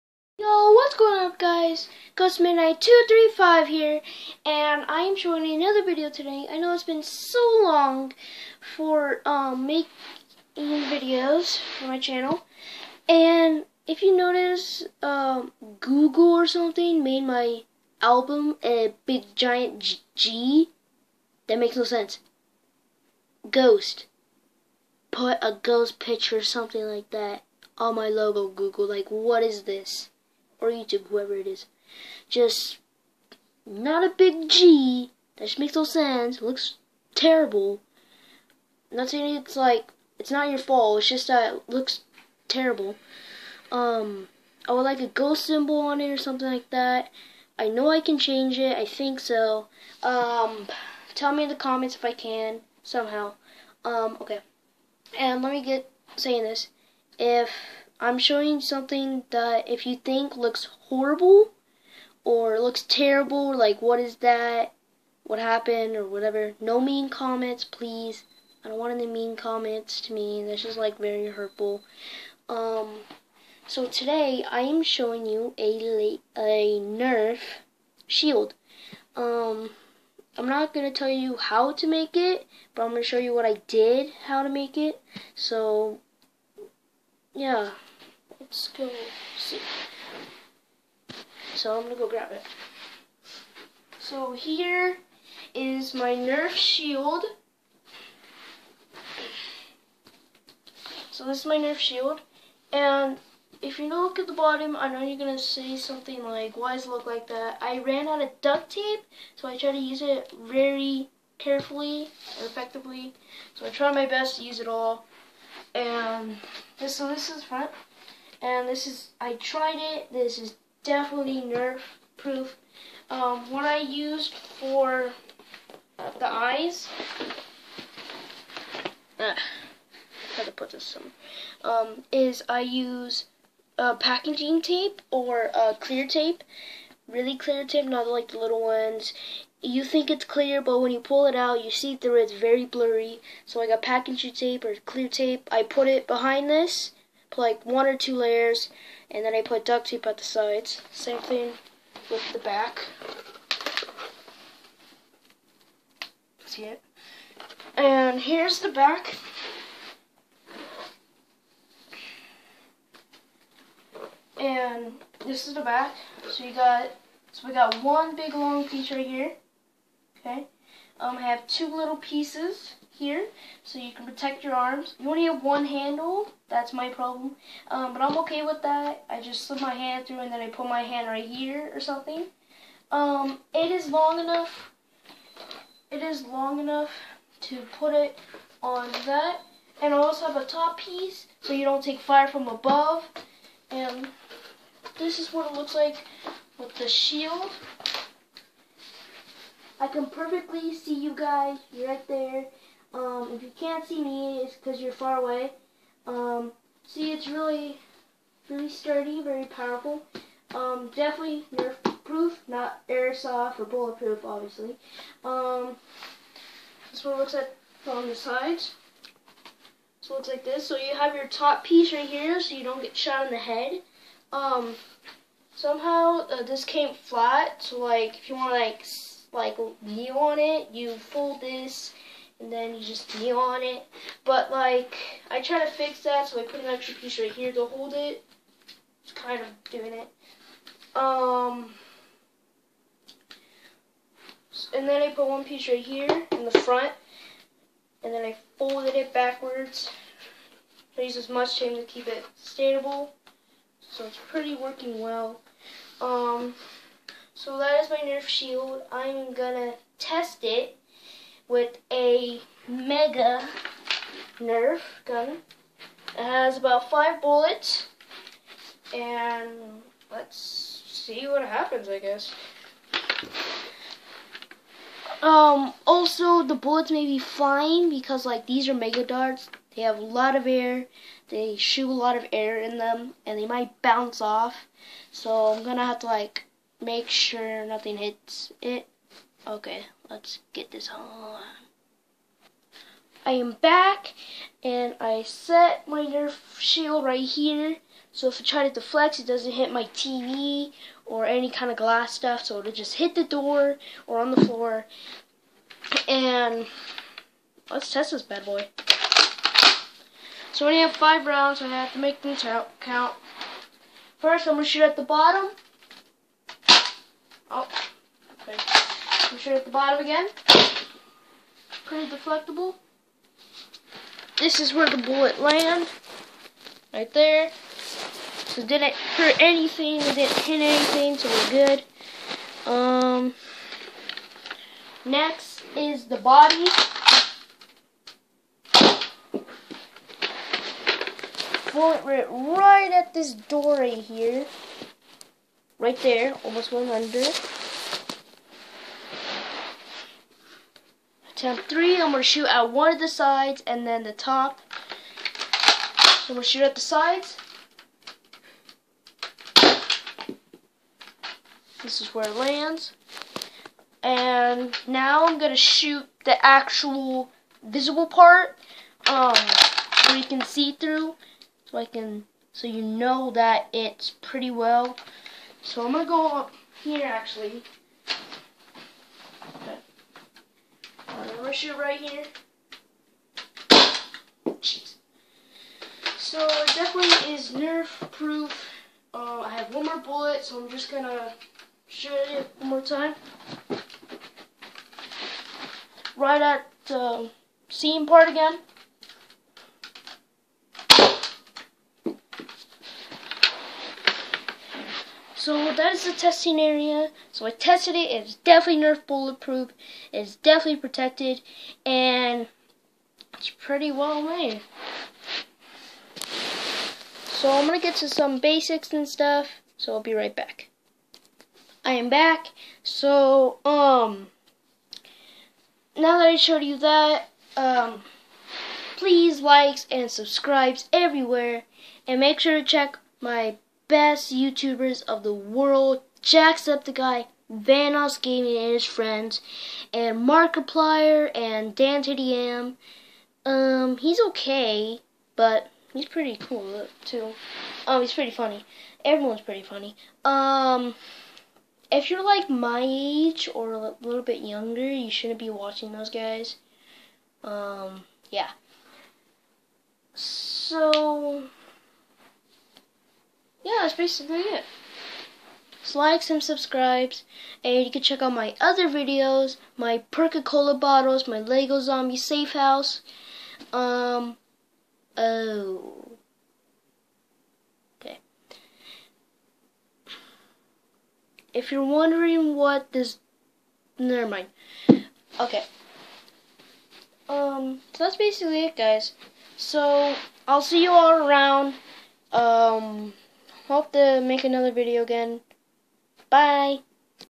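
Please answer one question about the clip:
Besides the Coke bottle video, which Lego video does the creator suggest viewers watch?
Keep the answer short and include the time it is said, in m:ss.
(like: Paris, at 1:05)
Lego Zombie Safe House, at 7:51.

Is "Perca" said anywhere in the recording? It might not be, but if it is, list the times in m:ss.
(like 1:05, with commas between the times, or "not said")
7:50.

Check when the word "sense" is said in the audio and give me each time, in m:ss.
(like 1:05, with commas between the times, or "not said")
0:21, 0:35.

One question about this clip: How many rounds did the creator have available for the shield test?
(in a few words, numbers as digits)
5.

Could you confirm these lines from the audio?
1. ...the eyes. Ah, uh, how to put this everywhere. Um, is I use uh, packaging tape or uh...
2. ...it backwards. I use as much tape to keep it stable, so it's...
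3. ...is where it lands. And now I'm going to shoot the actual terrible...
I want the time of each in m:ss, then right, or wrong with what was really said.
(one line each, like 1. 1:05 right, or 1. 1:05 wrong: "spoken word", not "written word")
1. 2:05 wrong: "somewhere", not "everywhere"
2. 4:08 right
3. 6:01 wrong: "visible", not "terrible".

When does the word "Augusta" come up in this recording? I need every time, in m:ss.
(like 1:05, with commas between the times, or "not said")
not said.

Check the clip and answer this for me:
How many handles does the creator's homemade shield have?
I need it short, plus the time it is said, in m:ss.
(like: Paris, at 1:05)
1, at 2:55.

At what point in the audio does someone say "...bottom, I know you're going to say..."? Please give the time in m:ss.
1:44.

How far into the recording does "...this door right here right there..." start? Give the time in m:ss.
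5:43.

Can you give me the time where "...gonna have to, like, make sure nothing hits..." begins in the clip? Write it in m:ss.
4:45.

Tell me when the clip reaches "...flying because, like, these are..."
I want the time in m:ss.
4:37.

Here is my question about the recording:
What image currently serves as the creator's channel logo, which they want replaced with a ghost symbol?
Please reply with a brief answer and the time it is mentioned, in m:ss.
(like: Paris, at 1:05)
A big giant G, at 0:19.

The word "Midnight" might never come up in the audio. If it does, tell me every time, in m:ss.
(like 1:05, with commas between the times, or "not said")
0:02.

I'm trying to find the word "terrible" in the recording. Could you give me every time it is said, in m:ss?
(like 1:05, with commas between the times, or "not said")
0:37, 0:42, 1:02.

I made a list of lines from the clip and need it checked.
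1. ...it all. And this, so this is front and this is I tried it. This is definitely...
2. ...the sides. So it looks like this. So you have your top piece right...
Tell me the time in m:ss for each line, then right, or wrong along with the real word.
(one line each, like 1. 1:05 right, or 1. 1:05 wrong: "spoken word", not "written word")
1. 1:54 right
2. 3:38 right.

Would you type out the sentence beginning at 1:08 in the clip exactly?
I don't want any mean comments to me.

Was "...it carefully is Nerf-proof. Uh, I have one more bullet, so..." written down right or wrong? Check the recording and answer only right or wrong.
wrong.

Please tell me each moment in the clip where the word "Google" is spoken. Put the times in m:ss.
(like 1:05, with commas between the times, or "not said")
0:15, 0:28.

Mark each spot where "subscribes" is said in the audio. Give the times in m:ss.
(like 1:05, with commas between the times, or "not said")
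7:10, 7:46.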